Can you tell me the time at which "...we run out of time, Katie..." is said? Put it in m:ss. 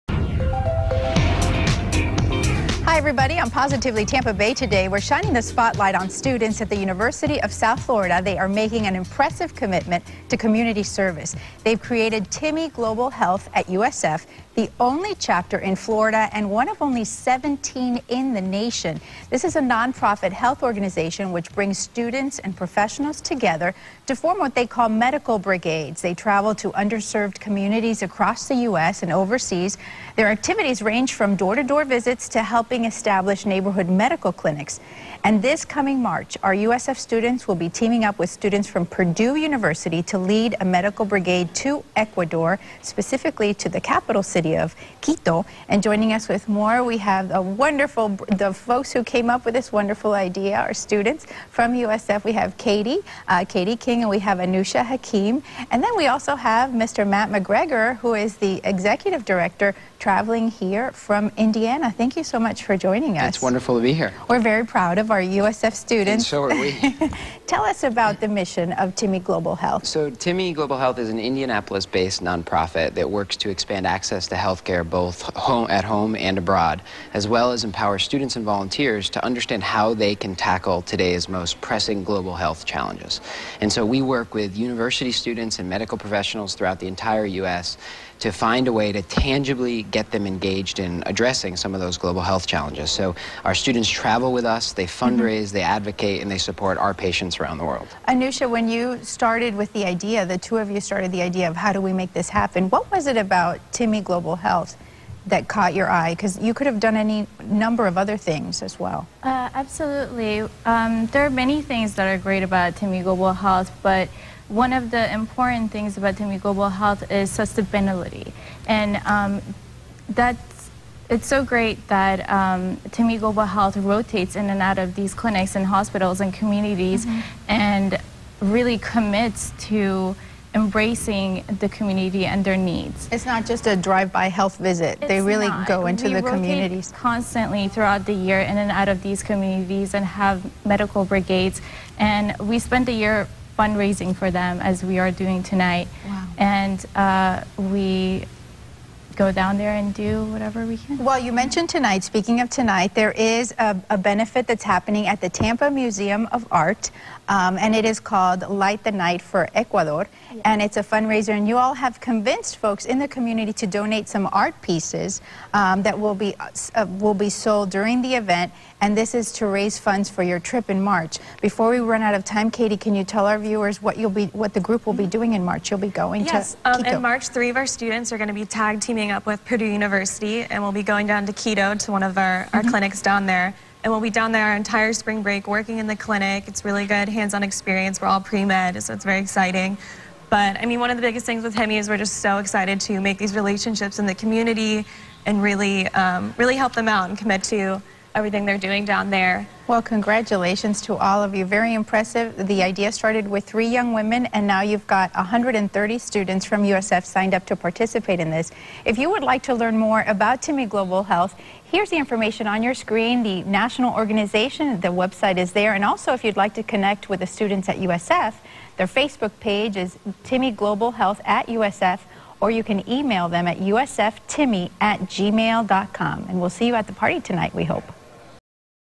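2:51.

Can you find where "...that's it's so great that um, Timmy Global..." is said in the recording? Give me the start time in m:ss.
2:00.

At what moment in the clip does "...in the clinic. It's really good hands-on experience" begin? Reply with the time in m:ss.
3:05.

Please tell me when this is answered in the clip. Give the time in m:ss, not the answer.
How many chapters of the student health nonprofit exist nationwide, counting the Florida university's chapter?
0:17.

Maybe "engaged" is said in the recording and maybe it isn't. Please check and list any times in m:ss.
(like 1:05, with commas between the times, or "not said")
1:30.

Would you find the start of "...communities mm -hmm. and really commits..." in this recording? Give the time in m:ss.
2:06.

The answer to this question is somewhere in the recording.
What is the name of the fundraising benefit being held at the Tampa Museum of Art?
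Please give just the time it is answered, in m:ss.
2:38.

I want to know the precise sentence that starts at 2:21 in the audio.
And we spend the year fundraising for them as we are doing tonight.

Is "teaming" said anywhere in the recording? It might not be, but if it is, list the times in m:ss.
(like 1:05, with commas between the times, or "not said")
0:37, 2:58.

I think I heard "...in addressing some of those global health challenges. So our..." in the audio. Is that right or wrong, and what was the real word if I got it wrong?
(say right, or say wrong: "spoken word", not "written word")
right.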